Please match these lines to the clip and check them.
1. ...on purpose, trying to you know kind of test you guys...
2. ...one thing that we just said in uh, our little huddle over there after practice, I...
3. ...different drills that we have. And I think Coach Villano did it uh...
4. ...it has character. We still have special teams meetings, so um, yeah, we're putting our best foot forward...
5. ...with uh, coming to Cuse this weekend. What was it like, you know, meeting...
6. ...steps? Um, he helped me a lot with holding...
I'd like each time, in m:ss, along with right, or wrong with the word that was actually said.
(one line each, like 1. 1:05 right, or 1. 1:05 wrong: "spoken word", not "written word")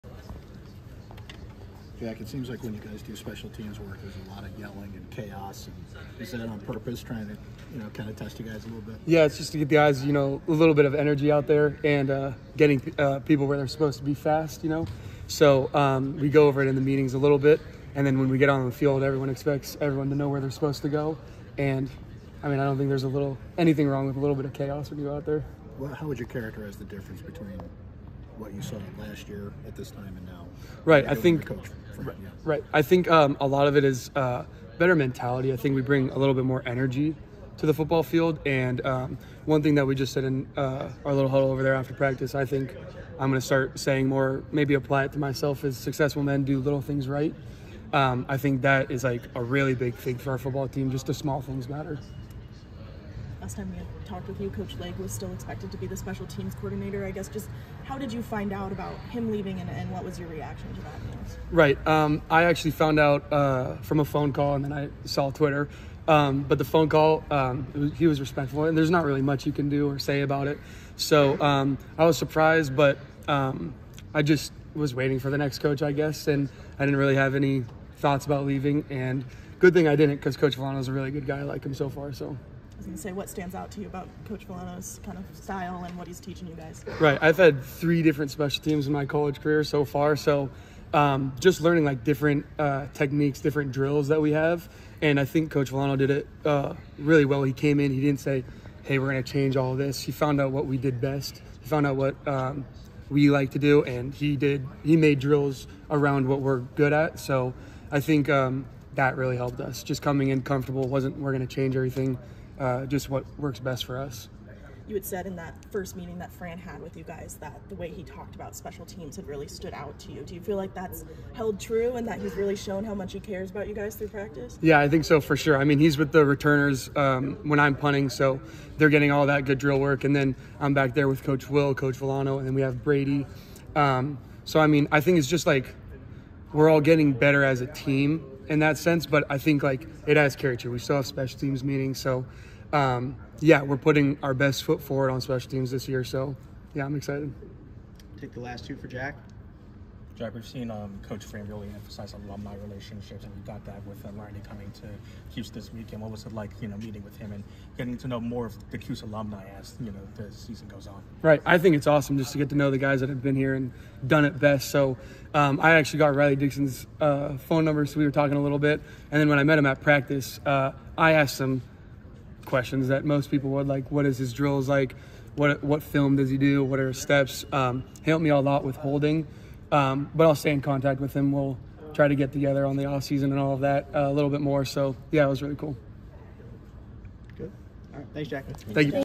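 1. 0:06 right
2. 0:39 right
3. 1:33 right
4. 2:20 right
5. 2:33 right
6. 2:57 right.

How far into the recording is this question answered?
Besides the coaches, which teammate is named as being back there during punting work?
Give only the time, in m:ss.
2:12.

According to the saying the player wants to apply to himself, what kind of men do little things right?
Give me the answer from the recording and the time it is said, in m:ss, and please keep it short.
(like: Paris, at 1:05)
successful men, at 0:45.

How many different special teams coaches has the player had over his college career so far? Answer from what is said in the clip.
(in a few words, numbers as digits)
3.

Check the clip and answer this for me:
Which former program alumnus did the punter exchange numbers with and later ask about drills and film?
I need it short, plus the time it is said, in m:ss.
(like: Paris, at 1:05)
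Riley Dixon, at 2:46.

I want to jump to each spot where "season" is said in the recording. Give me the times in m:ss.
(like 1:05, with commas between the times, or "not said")
2:40, 3:03.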